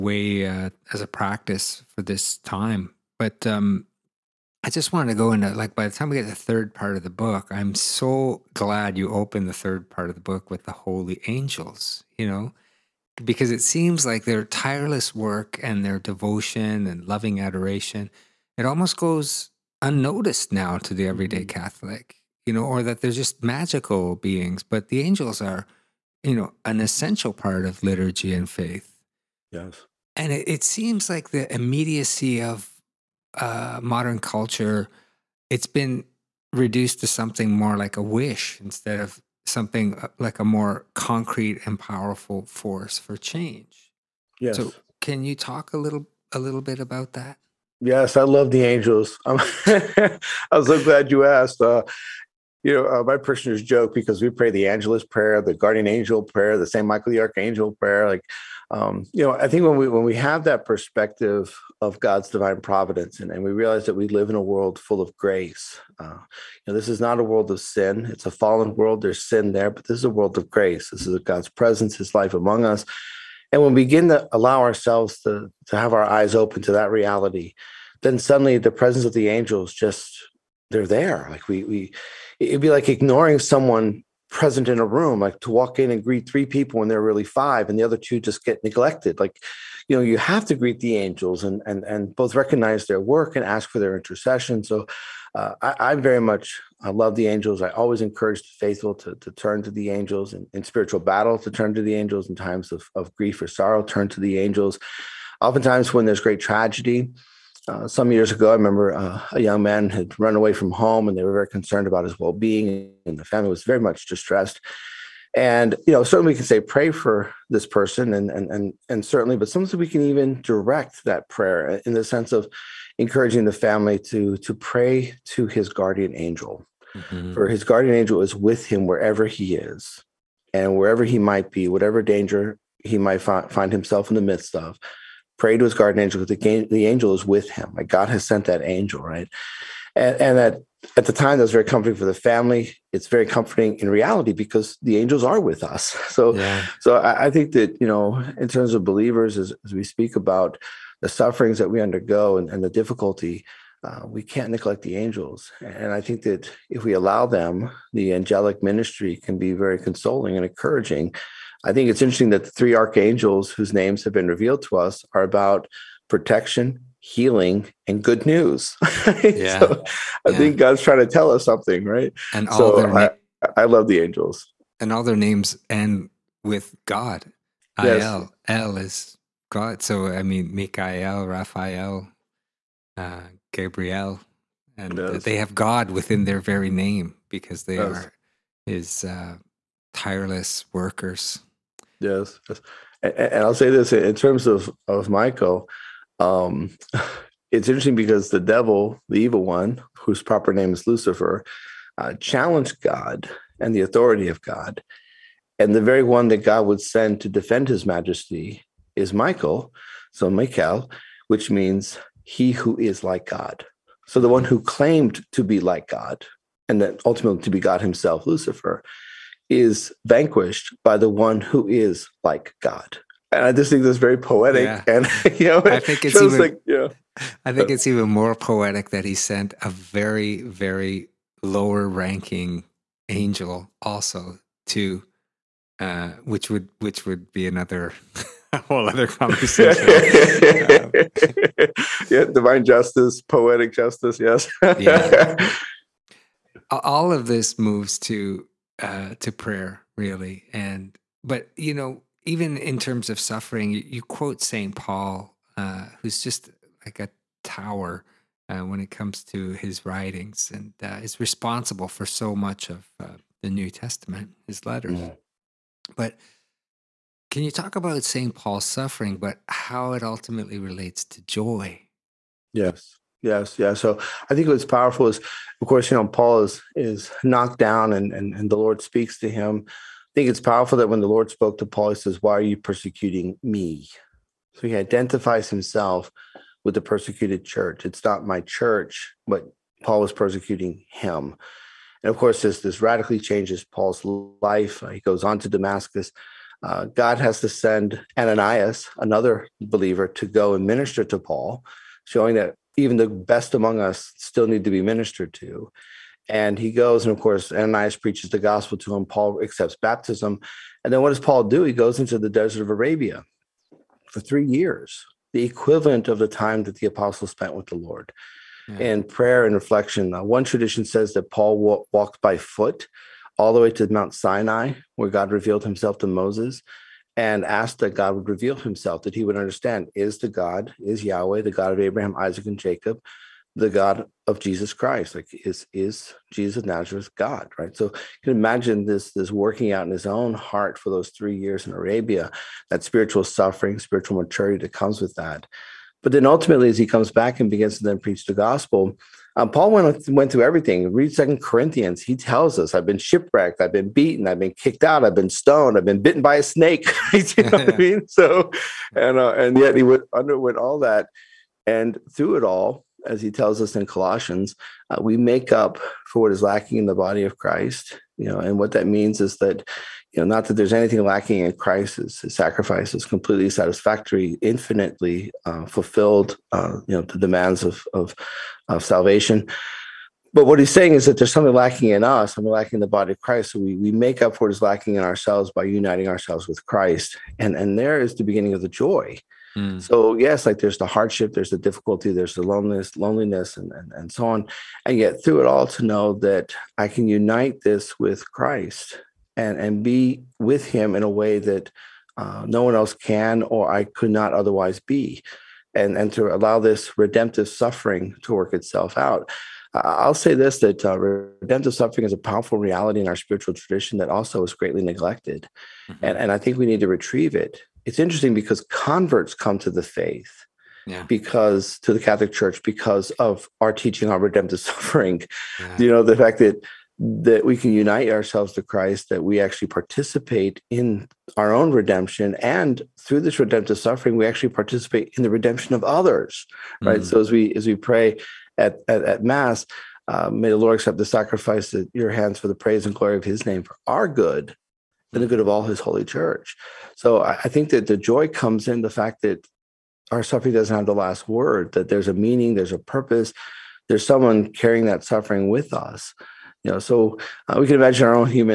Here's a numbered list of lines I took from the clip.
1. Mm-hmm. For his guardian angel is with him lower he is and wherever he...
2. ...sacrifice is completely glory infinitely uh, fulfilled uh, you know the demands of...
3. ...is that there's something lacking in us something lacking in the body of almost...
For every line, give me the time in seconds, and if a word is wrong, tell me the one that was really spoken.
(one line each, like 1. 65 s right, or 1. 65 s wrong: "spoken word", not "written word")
1. 126 s wrong: "wherever", not "lower"
2. 372 s wrong: "satisfactory", not "glory"
3. 380 s wrong: "christ", not "almost".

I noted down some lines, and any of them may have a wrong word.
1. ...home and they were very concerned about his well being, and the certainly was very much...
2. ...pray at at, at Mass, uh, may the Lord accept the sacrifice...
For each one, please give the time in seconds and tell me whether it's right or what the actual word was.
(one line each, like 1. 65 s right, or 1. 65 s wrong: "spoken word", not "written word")
1. 110 s wrong: "family", not "certainly"
2. 437 s right.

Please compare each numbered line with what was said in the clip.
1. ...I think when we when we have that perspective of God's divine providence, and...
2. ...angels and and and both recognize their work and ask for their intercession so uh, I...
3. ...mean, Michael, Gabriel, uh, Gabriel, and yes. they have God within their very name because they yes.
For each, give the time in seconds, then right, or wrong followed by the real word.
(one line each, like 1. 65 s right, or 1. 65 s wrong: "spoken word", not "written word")
1. 59 s right
2. 90 s right
3. 180 s wrong: "Raphael", not "Gabriel".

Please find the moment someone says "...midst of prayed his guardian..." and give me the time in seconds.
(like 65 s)
134 s.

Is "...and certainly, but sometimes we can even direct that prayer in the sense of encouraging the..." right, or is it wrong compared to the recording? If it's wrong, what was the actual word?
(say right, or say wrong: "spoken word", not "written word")
right.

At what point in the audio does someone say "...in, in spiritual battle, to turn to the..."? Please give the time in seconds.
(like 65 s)
100 s.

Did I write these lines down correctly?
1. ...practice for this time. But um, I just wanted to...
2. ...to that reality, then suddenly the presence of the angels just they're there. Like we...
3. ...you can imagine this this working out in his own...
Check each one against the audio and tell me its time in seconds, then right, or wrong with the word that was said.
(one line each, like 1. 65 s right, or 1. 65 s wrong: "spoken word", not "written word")
1. 1 s right
2. 76 s right
3. 337 s right.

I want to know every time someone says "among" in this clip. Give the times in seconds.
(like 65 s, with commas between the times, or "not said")
72 s, 303 s.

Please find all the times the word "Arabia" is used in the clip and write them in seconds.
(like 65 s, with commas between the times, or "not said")
312 s, 341 s.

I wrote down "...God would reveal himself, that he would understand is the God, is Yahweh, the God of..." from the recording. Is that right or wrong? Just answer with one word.
right.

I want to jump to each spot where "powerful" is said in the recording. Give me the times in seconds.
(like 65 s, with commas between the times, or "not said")
41 s, 274 s, 280 s, 412 s.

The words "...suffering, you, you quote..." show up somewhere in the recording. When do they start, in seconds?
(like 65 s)
253 s.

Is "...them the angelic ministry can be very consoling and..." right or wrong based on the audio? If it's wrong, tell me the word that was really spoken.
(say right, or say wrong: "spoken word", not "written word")
right.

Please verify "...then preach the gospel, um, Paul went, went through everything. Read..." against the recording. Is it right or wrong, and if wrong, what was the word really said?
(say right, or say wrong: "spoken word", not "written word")
right.